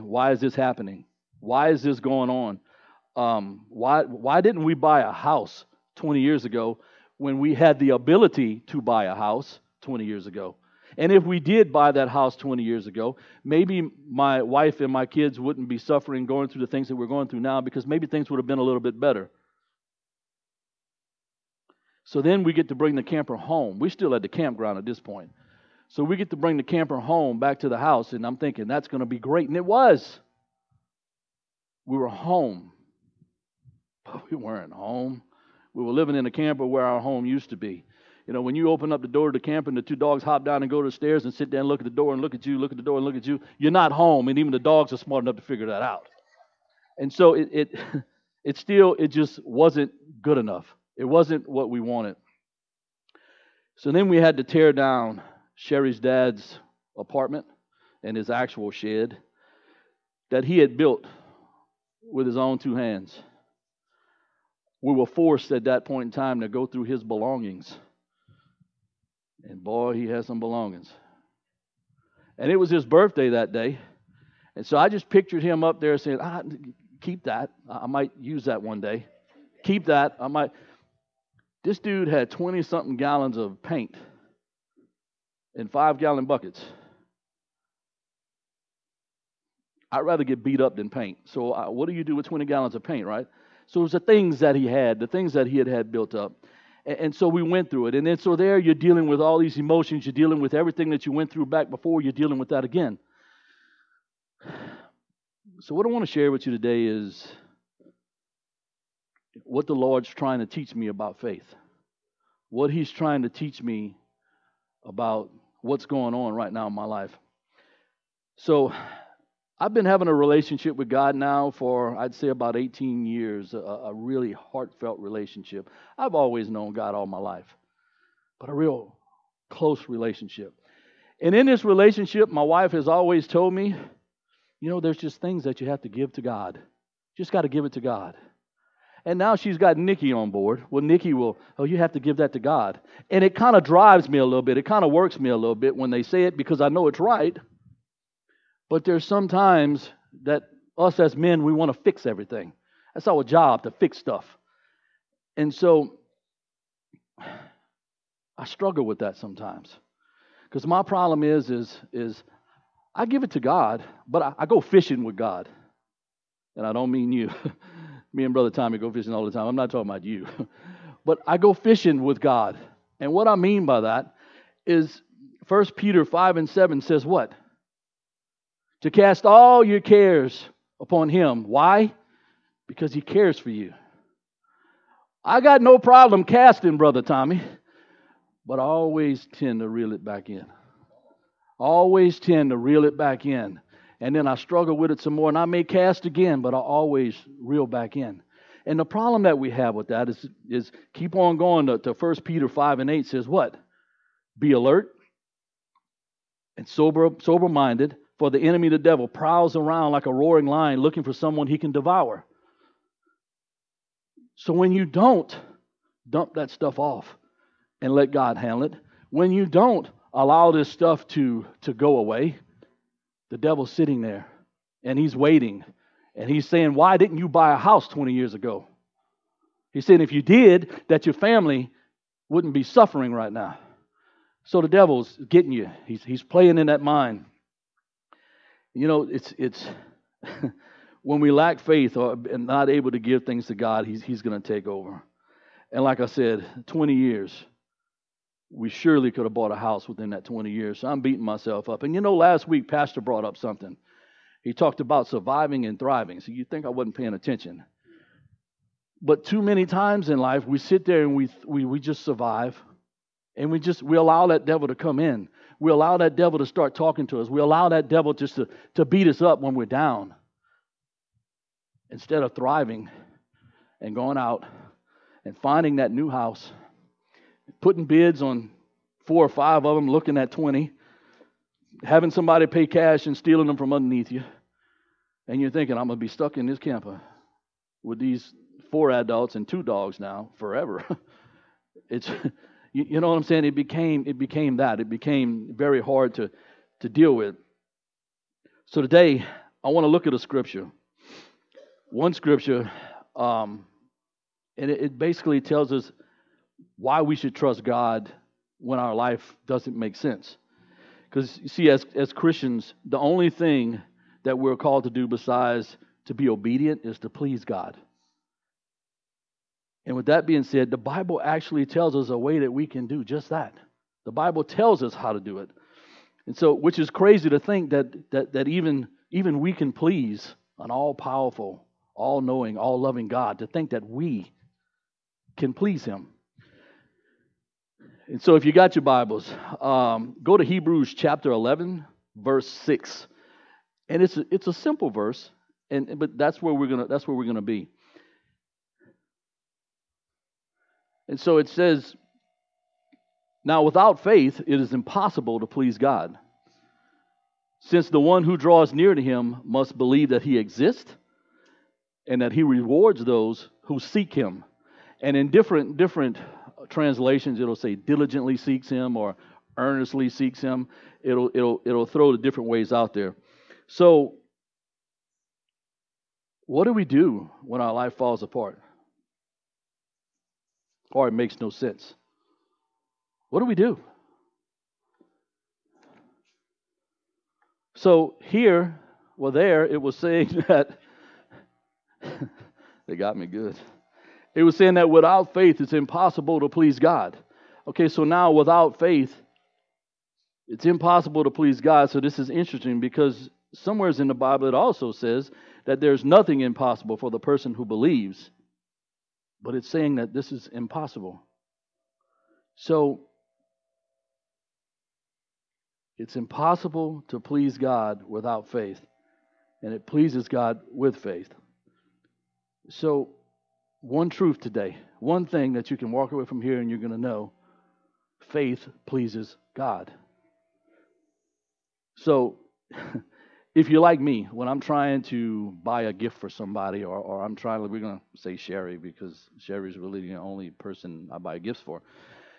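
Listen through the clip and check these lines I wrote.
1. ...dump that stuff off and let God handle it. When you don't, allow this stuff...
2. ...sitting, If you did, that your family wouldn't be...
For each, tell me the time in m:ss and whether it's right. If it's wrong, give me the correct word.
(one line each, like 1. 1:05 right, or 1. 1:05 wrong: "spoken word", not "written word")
1. 3:36 right
2. 3:49 wrong: "saying", not "sitting".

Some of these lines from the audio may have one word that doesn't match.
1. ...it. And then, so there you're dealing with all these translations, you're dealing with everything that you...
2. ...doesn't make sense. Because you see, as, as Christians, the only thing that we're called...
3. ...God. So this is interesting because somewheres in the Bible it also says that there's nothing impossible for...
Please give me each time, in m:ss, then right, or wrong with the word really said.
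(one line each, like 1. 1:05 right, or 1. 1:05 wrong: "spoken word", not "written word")
1. 1:37 wrong: "emotions", not "translations"
2. 5:09 right
3. 6:41 right.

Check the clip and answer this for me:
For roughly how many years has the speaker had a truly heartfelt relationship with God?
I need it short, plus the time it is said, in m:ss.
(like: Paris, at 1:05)
18 years, at 2:02.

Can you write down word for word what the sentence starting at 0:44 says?
And even the dogs are smart enough to figure that out.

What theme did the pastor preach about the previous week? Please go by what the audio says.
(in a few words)
surviving and thriving.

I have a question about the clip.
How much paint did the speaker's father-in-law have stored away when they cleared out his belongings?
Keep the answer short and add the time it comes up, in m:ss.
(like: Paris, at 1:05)
20 gallons, at 1:32.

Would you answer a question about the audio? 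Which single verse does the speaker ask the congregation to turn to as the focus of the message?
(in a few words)
Hebrews 11:6.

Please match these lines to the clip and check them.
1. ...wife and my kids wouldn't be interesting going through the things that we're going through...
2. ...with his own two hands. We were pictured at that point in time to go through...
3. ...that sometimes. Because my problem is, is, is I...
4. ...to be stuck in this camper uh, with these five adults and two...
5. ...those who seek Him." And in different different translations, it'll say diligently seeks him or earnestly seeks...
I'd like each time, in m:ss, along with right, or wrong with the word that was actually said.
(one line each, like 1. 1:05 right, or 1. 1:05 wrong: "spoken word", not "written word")
1. 0:14 wrong: "suffering", not "interesting"
2. 1:02 wrong: "forced", not "pictured"
3. 2:39 right
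4. 4:45 wrong: "four", not "five"
5. 6:03 right.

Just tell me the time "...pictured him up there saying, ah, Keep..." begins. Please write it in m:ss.
1:15.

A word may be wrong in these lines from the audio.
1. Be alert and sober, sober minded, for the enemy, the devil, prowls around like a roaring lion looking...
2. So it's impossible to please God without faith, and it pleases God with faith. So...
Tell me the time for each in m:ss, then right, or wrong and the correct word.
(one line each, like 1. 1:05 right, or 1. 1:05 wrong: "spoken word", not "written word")
1. 3:24 right
2. 6:52 right.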